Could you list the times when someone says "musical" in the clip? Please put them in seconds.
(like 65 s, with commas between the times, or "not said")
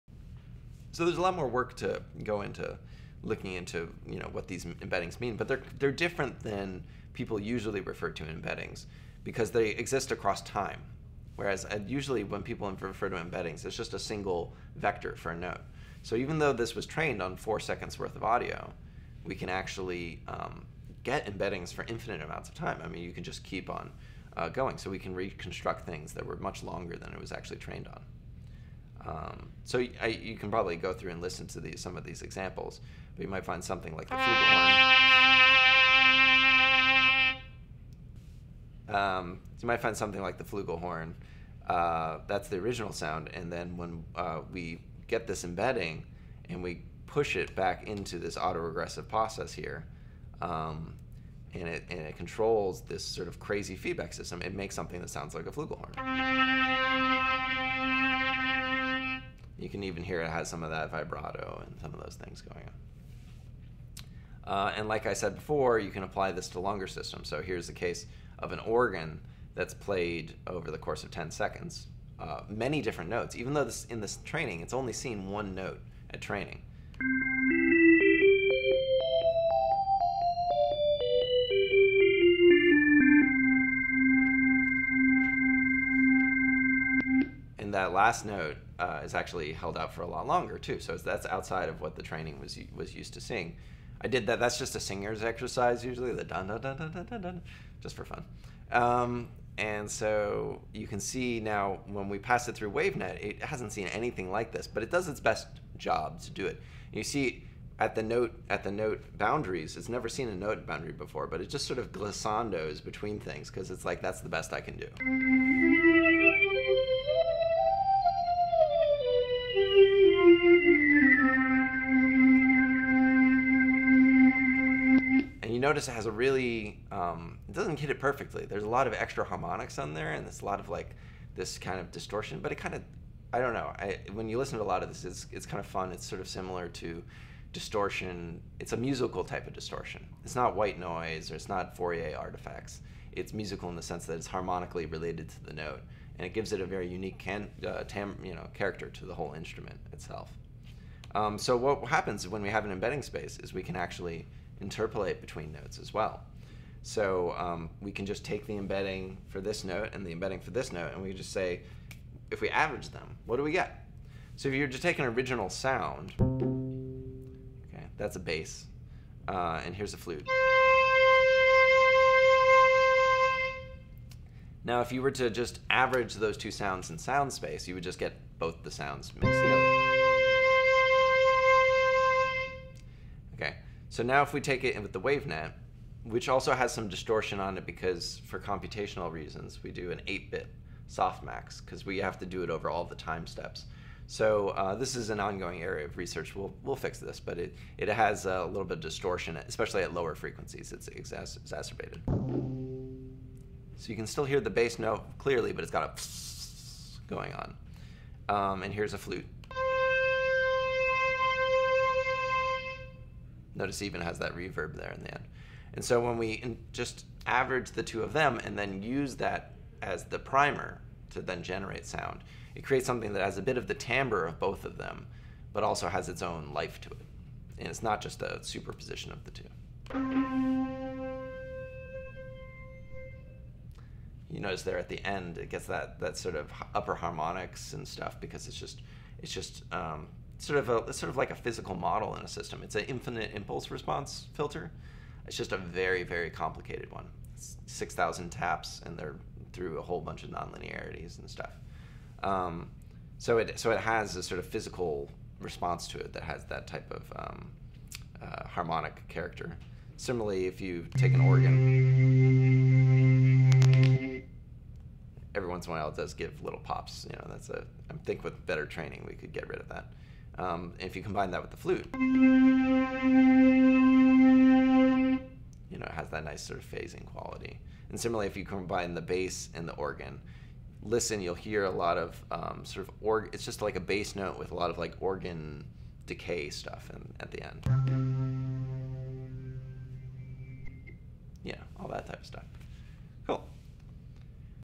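138 s, 143 s.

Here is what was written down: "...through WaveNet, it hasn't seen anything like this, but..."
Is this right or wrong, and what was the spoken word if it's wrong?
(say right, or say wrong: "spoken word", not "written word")
right.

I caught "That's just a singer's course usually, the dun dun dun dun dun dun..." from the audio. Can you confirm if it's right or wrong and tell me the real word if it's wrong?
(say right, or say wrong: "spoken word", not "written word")
wrong: "exercise", not "course".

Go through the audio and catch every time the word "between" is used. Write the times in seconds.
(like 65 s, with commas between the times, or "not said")
112 s, 155 s.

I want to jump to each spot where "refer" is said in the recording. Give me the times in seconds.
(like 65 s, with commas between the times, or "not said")
7 s, 12 s.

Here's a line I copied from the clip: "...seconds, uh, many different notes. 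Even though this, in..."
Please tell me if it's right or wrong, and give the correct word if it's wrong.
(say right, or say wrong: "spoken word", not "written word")
right.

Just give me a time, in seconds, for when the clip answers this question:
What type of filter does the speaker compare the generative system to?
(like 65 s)
242 s.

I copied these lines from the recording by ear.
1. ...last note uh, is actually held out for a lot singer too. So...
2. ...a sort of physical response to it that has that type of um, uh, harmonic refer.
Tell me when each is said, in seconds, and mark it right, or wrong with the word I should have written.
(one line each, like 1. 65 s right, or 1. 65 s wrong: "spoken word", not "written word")
1. 87 s wrong: "longer", not "singer"
2. 254 s wrong: "character", not "refer".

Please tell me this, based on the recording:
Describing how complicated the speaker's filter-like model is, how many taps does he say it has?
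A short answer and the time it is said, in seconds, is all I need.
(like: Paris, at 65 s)
6000, at 247 s.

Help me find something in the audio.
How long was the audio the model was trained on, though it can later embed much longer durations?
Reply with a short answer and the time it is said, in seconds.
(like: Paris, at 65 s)
4 seconds, at 17 s.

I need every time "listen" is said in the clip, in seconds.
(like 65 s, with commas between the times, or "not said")
31 s, 134 s, 280 s.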